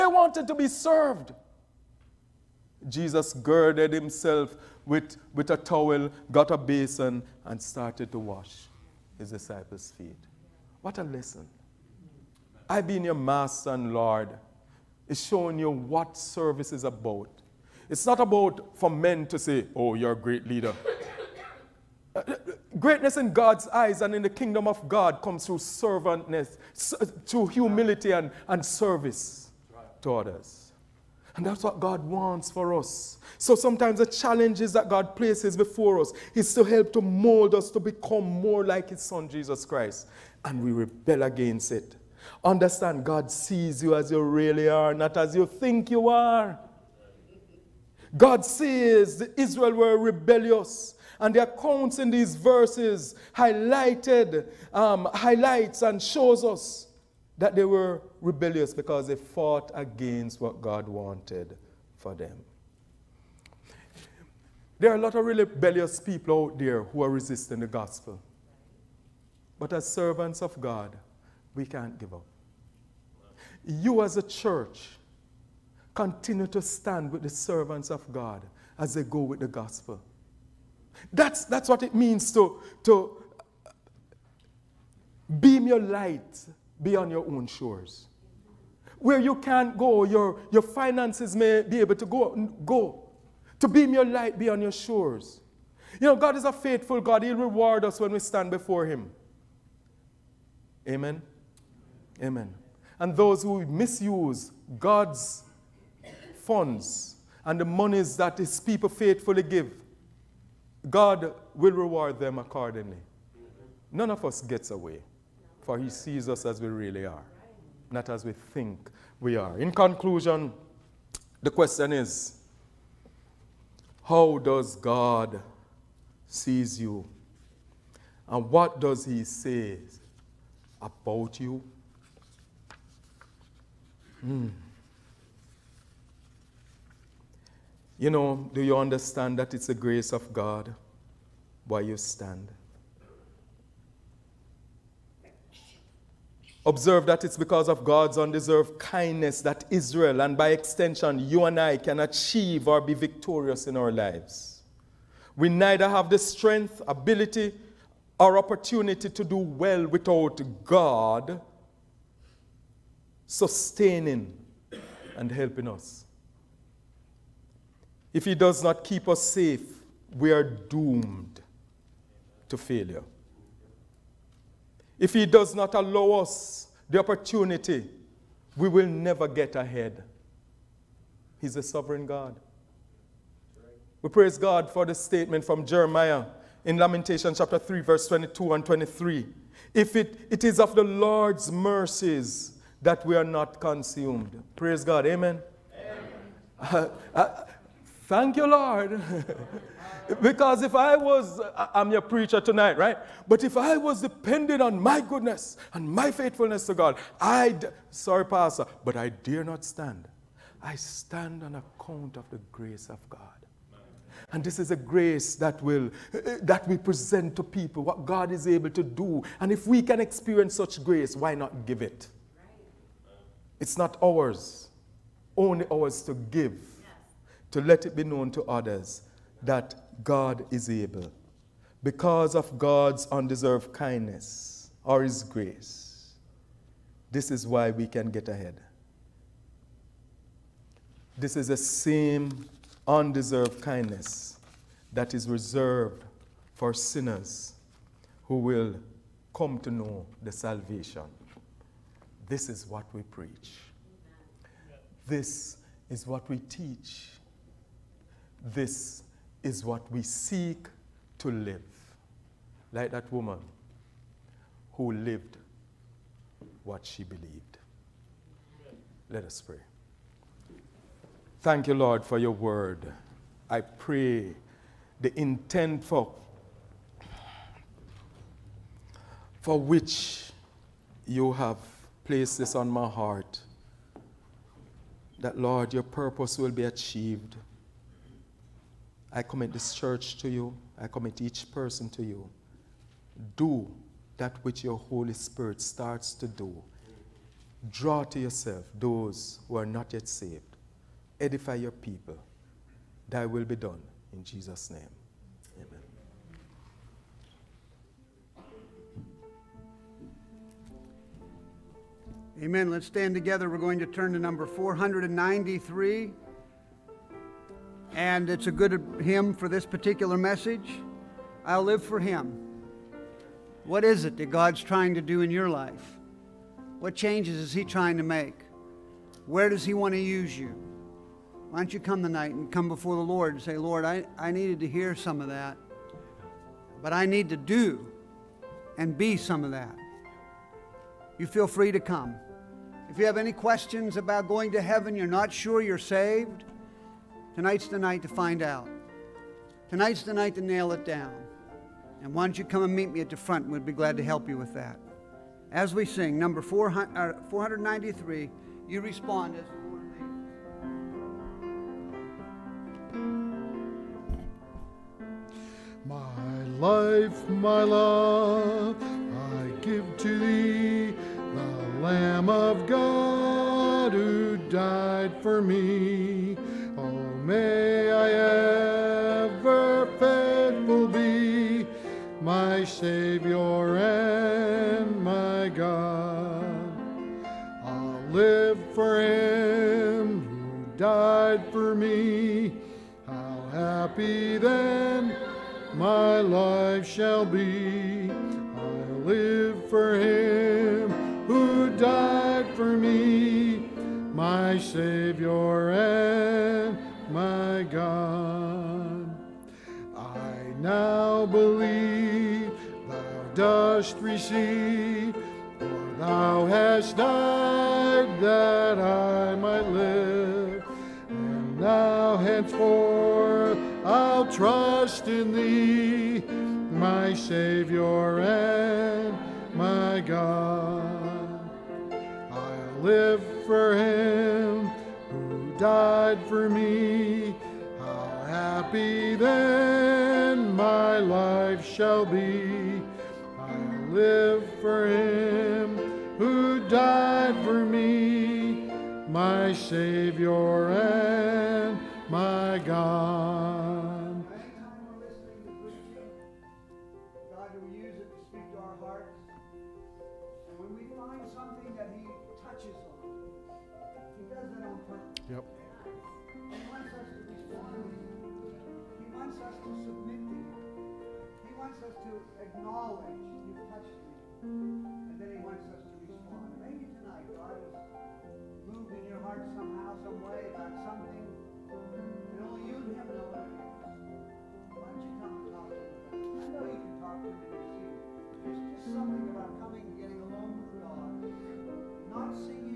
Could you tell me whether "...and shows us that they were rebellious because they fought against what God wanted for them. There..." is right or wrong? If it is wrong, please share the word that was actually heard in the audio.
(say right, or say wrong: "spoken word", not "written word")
right.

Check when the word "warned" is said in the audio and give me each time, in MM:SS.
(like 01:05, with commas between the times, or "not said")
not said.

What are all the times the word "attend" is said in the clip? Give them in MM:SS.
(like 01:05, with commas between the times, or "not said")
not said.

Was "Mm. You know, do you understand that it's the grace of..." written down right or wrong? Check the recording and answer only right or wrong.
right.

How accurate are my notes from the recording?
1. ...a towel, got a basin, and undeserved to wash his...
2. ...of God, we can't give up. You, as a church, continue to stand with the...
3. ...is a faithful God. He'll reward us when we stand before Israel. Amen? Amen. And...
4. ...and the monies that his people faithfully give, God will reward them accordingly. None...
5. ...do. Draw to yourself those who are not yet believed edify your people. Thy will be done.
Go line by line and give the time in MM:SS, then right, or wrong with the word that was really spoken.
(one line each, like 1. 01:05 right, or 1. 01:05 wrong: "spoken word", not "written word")
1. 00:05 wrong: "started", not "undeserved"
2. 01:10 right
3. 01:36 wrong: "Him", not "Israel"
4. 01:47 right
5. 04:56 wrong: "saved", not "believed".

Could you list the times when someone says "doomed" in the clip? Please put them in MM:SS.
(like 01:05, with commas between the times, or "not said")
02:50.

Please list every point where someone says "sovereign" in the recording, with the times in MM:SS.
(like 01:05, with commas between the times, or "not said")
03:01.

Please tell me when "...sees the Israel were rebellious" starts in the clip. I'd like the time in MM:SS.
00:48.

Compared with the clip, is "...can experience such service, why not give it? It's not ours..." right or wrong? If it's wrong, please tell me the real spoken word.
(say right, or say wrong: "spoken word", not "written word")
wrong: "grace", not "service".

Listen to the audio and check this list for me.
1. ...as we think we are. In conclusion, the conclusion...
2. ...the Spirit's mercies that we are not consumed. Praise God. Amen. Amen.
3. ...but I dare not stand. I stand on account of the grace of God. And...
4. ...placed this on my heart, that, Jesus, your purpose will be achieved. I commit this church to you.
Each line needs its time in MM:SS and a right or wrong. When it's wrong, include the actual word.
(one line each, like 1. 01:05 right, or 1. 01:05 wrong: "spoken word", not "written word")
1. 01:58 wrong: "question", not "conclusion"
2. 03:10 wrong: "Lord", not "Spirit"
3. 03:28 right
4. 04:42 wrong: "Lord", not "Jesus".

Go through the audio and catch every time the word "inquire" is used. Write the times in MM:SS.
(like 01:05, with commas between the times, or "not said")
not said.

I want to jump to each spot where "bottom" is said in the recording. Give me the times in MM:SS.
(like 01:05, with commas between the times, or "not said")
not said.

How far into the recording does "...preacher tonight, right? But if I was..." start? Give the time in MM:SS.
03:21.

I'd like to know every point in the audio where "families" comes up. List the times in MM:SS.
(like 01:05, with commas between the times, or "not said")
not said.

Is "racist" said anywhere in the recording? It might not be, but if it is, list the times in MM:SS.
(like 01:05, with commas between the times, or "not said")
not said.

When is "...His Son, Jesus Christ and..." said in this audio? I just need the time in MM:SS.
00:38.